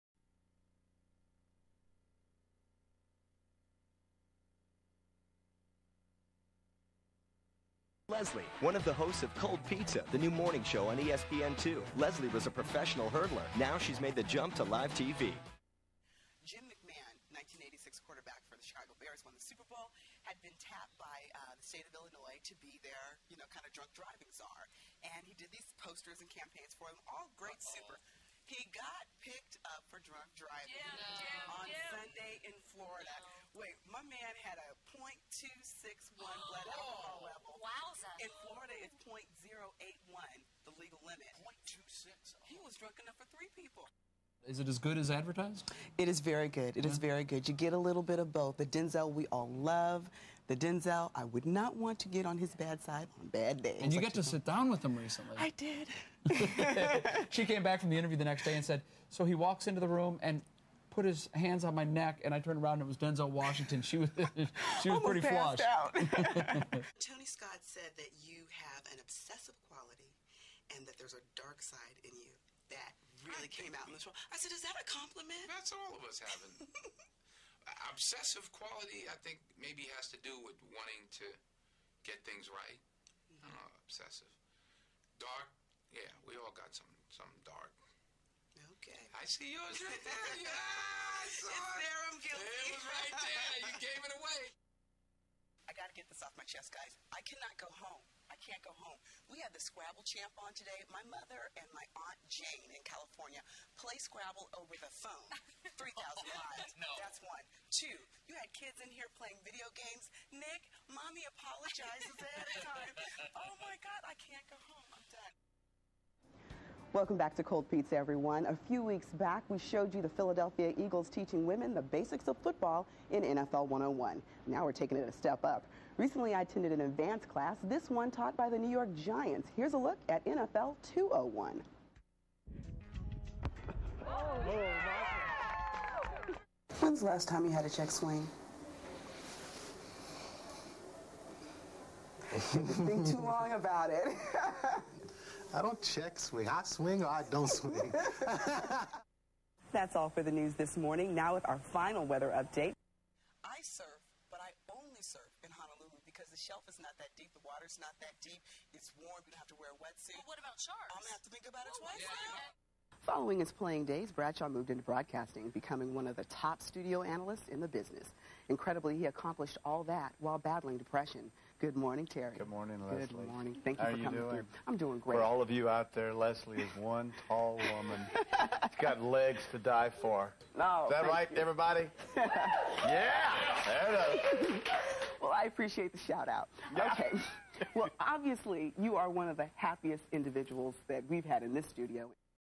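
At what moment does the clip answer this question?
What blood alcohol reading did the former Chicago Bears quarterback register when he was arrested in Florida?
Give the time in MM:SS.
00:34.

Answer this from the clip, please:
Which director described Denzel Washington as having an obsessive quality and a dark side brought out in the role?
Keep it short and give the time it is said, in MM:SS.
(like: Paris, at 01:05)
Tony Scott, at 01:06.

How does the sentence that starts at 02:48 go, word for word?
Incredibly, he accomplished all that while battling depression.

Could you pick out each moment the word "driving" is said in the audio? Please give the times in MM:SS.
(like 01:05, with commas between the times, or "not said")
00:23, 00:30.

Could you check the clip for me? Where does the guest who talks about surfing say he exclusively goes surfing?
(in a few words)
Honolulu.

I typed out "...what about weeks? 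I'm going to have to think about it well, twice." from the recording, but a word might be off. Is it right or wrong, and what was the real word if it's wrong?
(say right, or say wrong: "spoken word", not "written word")
wrong: "sharks", not "weeks".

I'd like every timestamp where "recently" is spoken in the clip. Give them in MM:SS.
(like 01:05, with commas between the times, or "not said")
00:54, 02:05.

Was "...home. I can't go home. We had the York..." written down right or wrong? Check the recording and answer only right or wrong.
wrong.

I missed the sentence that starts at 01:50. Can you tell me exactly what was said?
Nick, mommy apologizes ahead of time.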